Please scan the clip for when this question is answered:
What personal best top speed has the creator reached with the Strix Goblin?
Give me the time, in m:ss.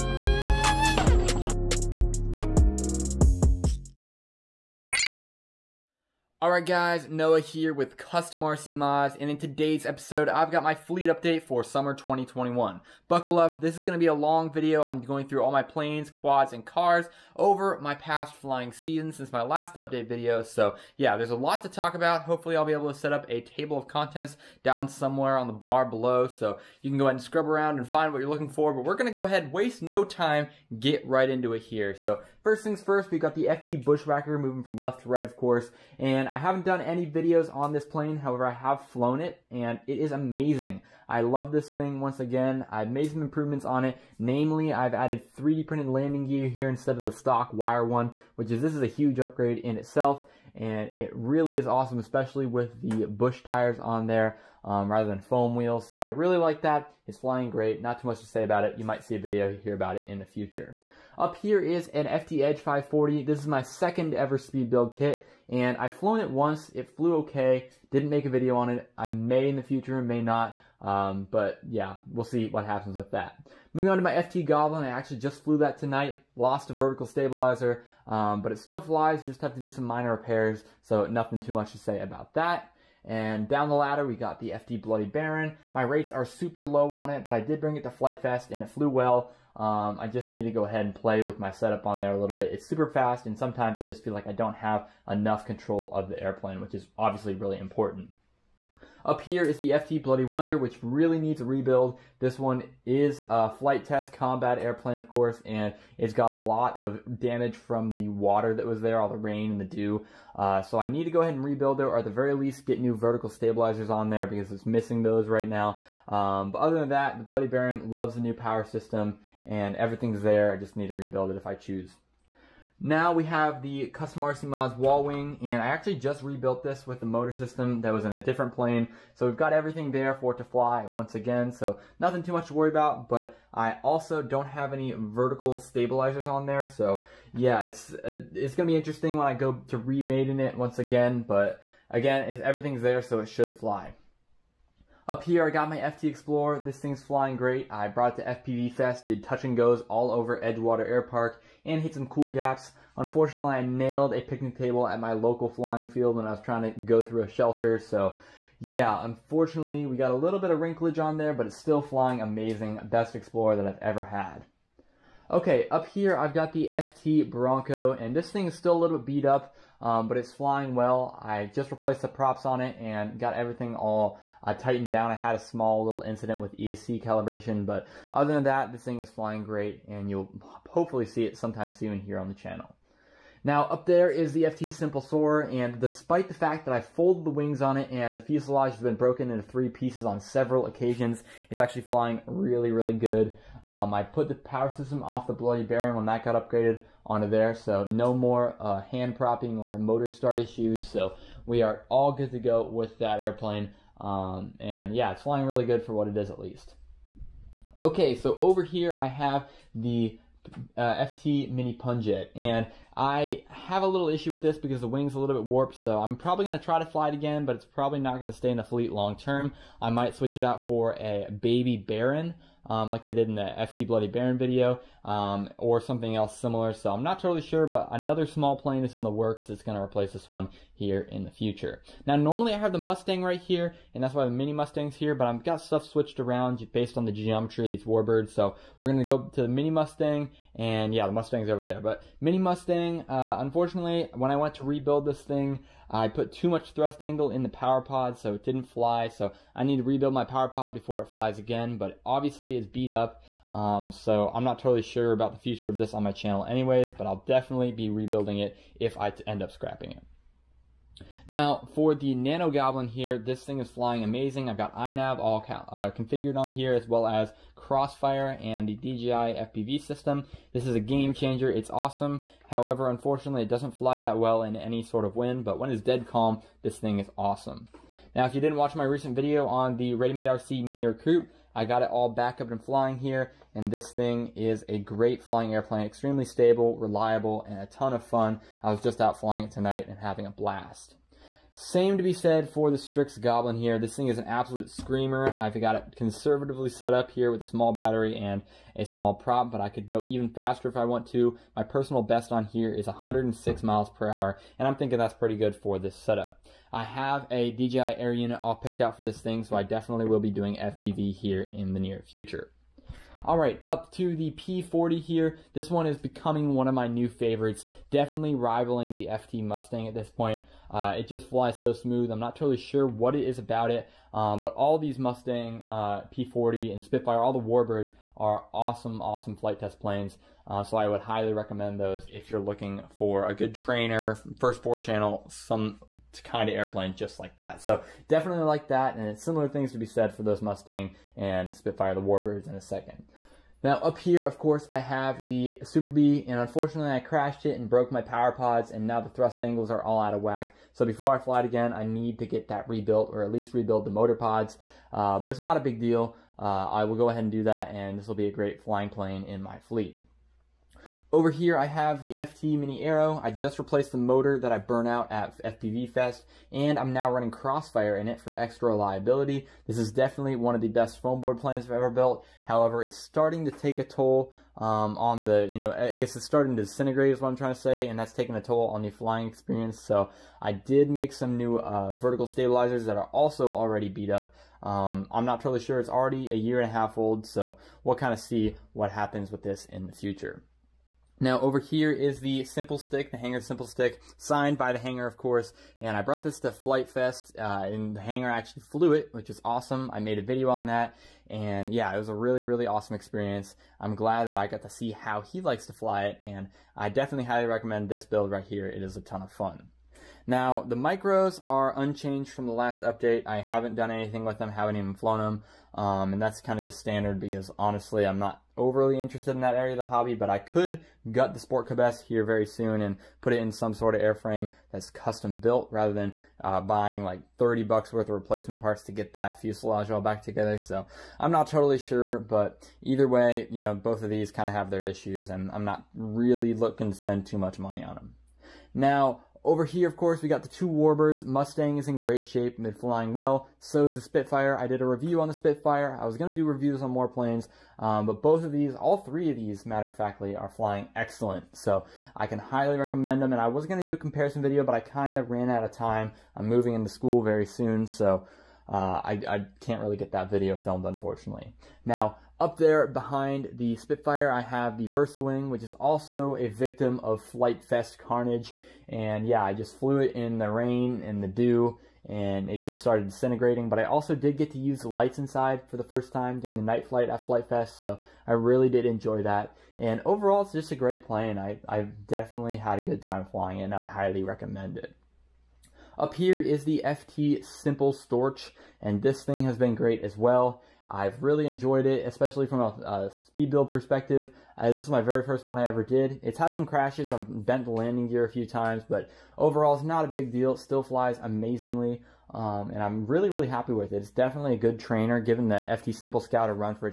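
5:02.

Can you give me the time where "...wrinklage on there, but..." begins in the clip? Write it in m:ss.
2:40.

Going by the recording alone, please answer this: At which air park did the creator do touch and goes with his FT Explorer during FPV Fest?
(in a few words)
Edgewater Air Park.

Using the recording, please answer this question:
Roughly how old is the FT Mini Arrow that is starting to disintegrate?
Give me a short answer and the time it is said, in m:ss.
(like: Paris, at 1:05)
a year and a half, at 6:26.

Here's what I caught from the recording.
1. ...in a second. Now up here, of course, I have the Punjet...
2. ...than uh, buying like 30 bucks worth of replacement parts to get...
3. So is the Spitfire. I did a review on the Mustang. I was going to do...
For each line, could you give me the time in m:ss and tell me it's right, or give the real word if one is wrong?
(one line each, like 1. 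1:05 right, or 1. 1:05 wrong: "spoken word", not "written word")
1. 5:42 wrong: "Super", not "Punjet"
2. 7:05 right
3. 7:23 wrong: "Spitfire", not "Mustang".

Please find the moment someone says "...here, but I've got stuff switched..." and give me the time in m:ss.
3:54.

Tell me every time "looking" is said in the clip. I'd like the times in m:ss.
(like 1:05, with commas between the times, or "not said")
0:28, 5:32, 7:16.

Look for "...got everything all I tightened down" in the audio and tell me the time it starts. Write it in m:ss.
2:53.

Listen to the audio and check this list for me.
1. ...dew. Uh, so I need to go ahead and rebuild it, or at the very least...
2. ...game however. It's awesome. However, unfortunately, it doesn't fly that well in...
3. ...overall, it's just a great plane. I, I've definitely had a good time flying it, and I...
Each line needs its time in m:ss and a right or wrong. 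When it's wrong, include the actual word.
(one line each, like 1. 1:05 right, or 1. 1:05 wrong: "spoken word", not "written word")
1. 1:49 right
2. 4:30 wrong: "changer", not "however"
3. 8:00 right.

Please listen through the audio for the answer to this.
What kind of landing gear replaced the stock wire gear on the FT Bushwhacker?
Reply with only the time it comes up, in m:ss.
0:45.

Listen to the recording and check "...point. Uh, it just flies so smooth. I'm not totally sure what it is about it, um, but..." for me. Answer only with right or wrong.
right.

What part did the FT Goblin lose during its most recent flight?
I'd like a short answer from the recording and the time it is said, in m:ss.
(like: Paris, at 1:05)
vertical stabilizer, at 1:16.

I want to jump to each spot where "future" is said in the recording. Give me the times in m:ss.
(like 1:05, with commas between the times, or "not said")
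1:00, 1:09, 3:51, 4:15, 5:12, 6:29.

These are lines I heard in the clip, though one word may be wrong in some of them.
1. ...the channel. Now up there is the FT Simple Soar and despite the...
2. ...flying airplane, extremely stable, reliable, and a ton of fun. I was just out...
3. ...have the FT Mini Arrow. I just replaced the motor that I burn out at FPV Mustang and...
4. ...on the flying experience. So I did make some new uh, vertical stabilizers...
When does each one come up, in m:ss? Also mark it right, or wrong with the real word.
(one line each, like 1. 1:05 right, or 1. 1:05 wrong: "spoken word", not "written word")
1. 3:02 right
2. 4:45 right
3. 6:01 wrong: "Fest", not "Mustang"
4. 6:18 right.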